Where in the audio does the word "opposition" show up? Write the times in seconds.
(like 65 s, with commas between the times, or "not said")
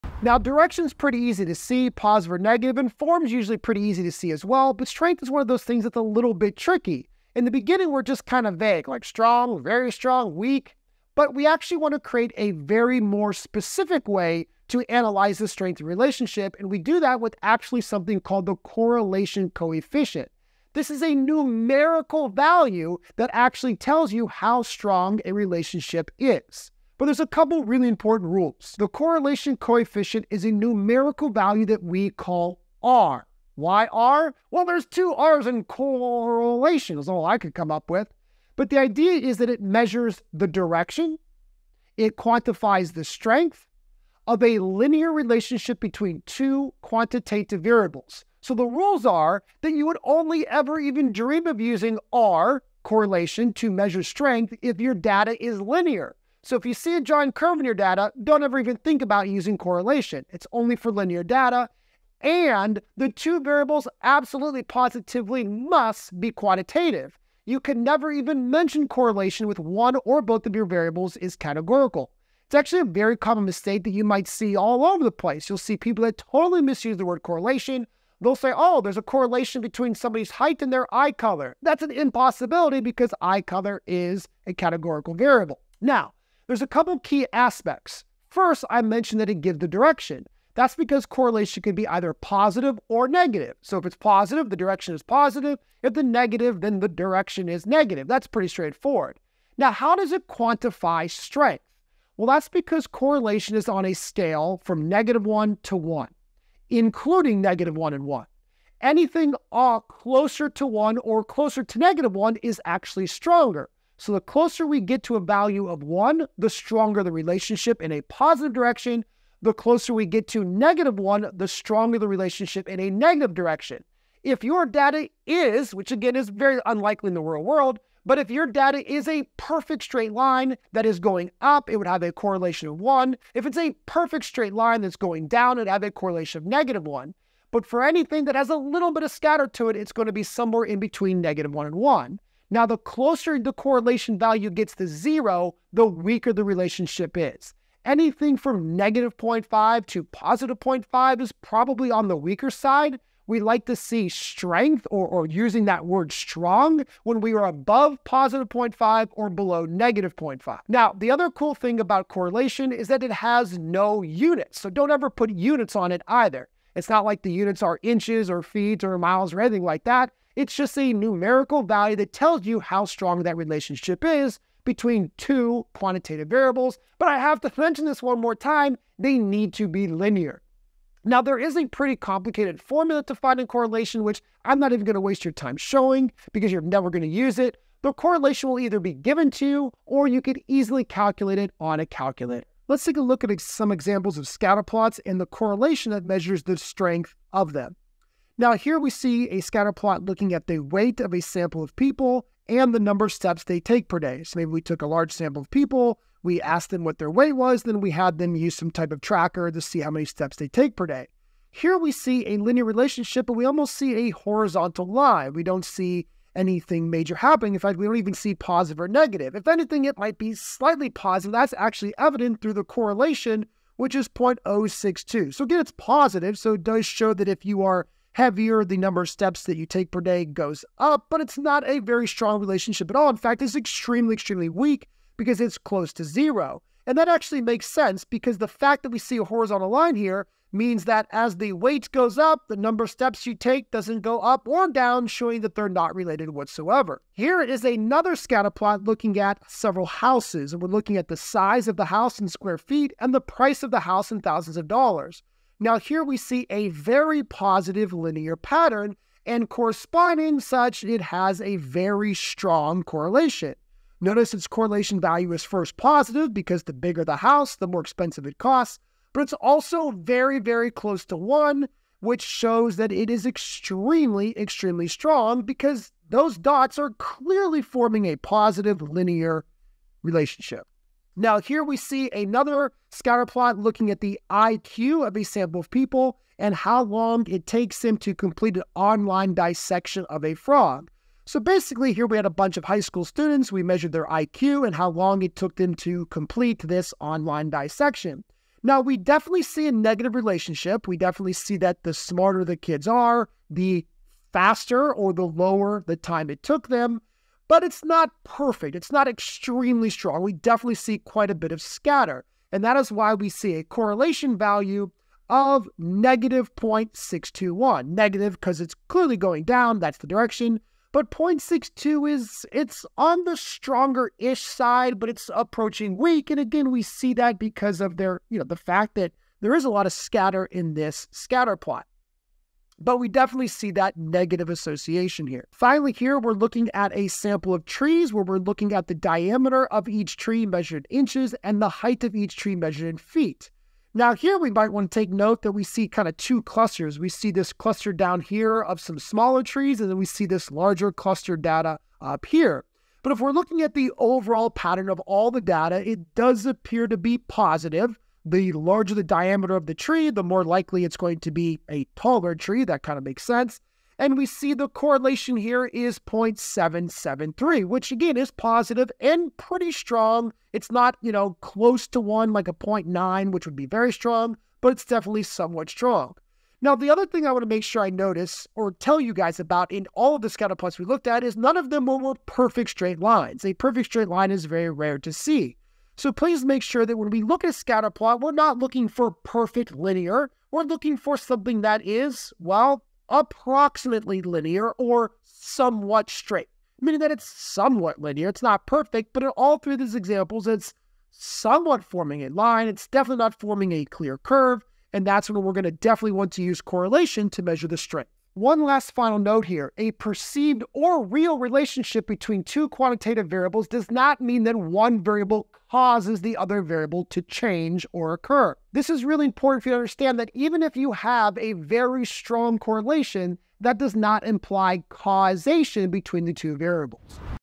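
not said.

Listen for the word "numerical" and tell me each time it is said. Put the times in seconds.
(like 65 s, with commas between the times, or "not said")
21 s, 30 s, 170 s.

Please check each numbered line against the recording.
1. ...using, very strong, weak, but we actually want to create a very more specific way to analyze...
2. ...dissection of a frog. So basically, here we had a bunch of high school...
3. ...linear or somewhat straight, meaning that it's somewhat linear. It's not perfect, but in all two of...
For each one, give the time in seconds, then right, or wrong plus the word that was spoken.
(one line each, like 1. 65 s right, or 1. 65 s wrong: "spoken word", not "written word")
1. 9 s wrong: "strong", not "using"
2. 289 s right
3. 394 s wrong: "three", not "two".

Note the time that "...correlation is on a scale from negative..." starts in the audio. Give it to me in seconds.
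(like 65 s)
102 s.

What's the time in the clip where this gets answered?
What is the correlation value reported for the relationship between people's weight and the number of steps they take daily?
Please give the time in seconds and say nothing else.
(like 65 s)
224 s.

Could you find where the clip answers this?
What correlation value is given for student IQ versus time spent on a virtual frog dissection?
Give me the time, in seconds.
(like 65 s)
315 s.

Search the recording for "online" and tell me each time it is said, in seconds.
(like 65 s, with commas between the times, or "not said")
288 s, 297 s.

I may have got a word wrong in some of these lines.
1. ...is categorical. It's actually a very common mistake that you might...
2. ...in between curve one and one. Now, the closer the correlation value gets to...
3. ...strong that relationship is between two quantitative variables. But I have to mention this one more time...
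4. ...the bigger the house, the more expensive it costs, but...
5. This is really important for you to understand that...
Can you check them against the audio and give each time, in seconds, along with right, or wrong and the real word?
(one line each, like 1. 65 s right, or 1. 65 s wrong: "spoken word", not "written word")
1. 71 s right
2. 140 s wrong: "negative", not "curve"
3. 172 s right
4. 266 s right
5. 418 s right.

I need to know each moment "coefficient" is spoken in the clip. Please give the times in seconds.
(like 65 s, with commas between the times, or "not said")
19 s, 29 s.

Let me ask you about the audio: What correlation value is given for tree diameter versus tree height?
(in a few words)
0.773.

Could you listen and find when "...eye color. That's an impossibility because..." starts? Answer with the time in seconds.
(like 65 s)
80 s.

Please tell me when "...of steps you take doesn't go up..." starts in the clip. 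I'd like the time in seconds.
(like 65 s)
242 s.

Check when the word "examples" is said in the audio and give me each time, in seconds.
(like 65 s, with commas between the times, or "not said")
193 s, 399 s.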